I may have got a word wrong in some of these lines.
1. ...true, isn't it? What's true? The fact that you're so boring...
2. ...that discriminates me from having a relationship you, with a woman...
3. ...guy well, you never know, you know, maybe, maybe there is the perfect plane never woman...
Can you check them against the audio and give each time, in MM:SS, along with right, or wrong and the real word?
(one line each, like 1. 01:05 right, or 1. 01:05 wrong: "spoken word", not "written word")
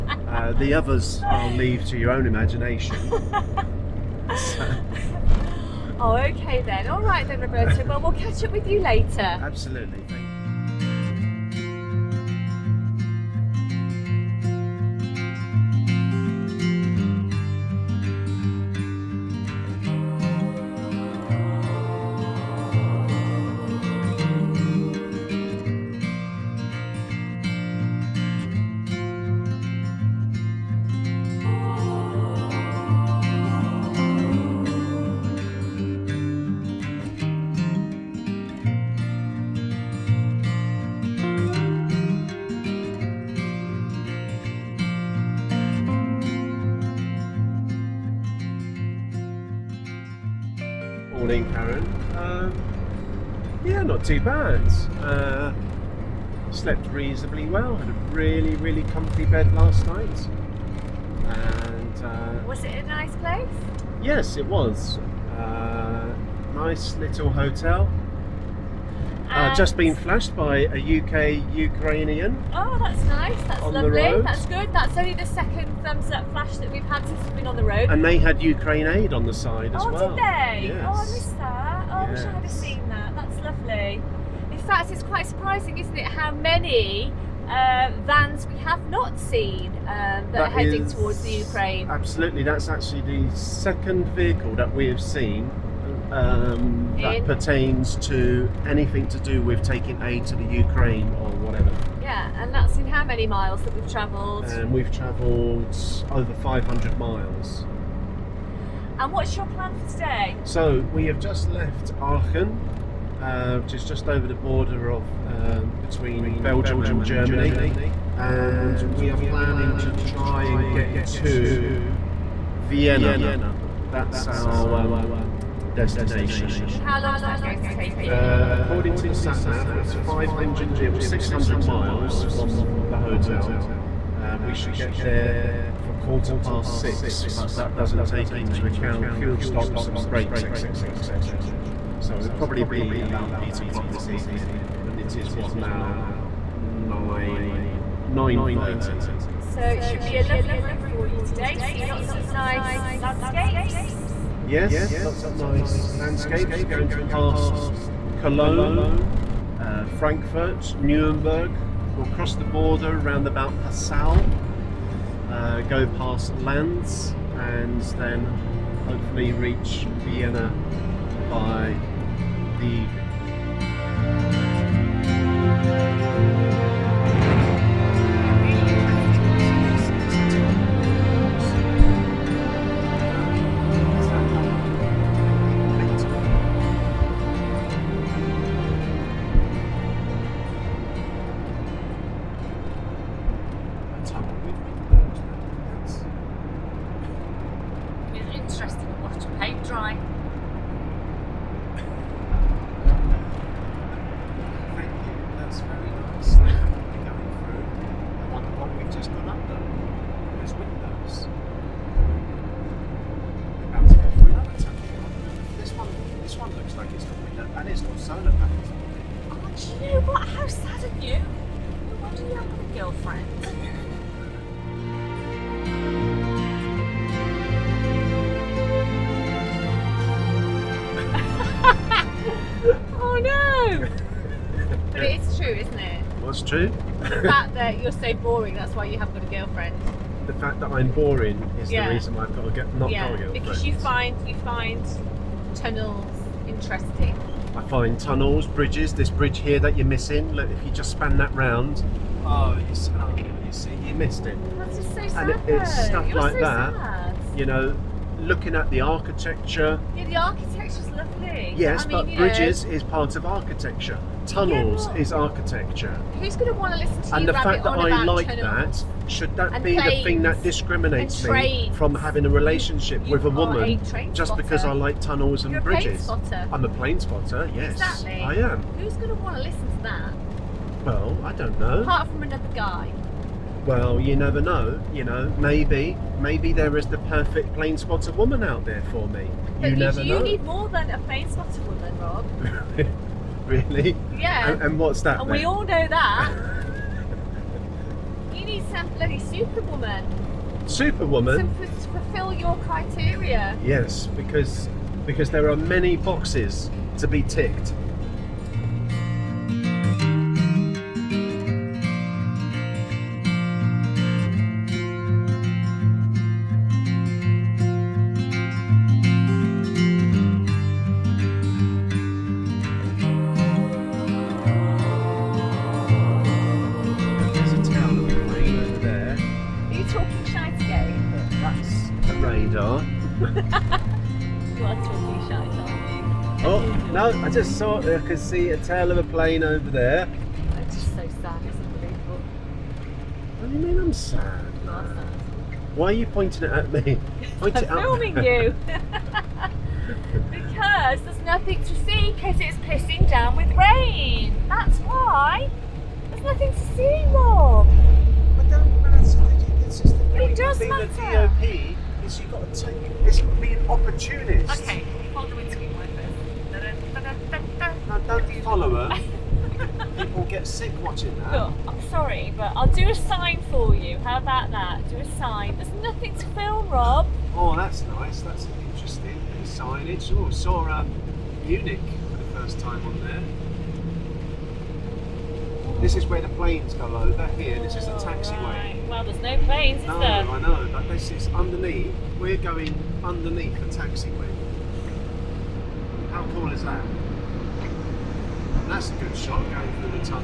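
1. 03:55 right
2. 04:30 right
3. 04:42 wrong: "spotter", not "never".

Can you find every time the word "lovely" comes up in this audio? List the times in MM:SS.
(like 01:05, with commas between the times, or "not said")
01:13, 01:23, 02:30, 04:20.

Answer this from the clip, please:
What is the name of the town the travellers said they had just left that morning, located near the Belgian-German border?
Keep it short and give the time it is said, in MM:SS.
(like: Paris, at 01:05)
Aachen, at 01:52.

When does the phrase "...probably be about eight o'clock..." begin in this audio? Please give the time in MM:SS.
02:22.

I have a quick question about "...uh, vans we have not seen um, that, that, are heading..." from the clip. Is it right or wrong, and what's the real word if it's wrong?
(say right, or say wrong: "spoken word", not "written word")
right.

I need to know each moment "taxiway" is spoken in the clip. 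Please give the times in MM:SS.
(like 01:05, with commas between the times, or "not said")
06:27, 06:33.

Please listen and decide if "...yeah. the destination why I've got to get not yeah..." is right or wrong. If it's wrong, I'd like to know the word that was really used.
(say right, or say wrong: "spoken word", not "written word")
wrong: "reason", not "destination".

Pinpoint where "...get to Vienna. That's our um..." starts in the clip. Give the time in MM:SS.
02:00.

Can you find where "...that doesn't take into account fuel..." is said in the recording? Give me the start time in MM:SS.
02:17.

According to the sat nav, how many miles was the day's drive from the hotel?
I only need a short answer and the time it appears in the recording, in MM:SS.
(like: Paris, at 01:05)
600, at 02:11.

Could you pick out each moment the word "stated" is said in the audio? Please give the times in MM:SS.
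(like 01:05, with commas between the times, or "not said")
not said.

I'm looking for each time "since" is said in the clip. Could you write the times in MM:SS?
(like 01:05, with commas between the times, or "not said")
01:17.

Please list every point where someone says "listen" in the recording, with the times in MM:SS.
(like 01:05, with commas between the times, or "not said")
04:26, 04:39.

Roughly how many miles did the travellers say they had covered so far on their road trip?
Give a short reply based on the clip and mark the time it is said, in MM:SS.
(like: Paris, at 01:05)
over 500, at 01:46.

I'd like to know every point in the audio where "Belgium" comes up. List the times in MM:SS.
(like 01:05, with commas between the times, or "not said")
01:56.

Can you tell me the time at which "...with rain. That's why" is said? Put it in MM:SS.
05:53.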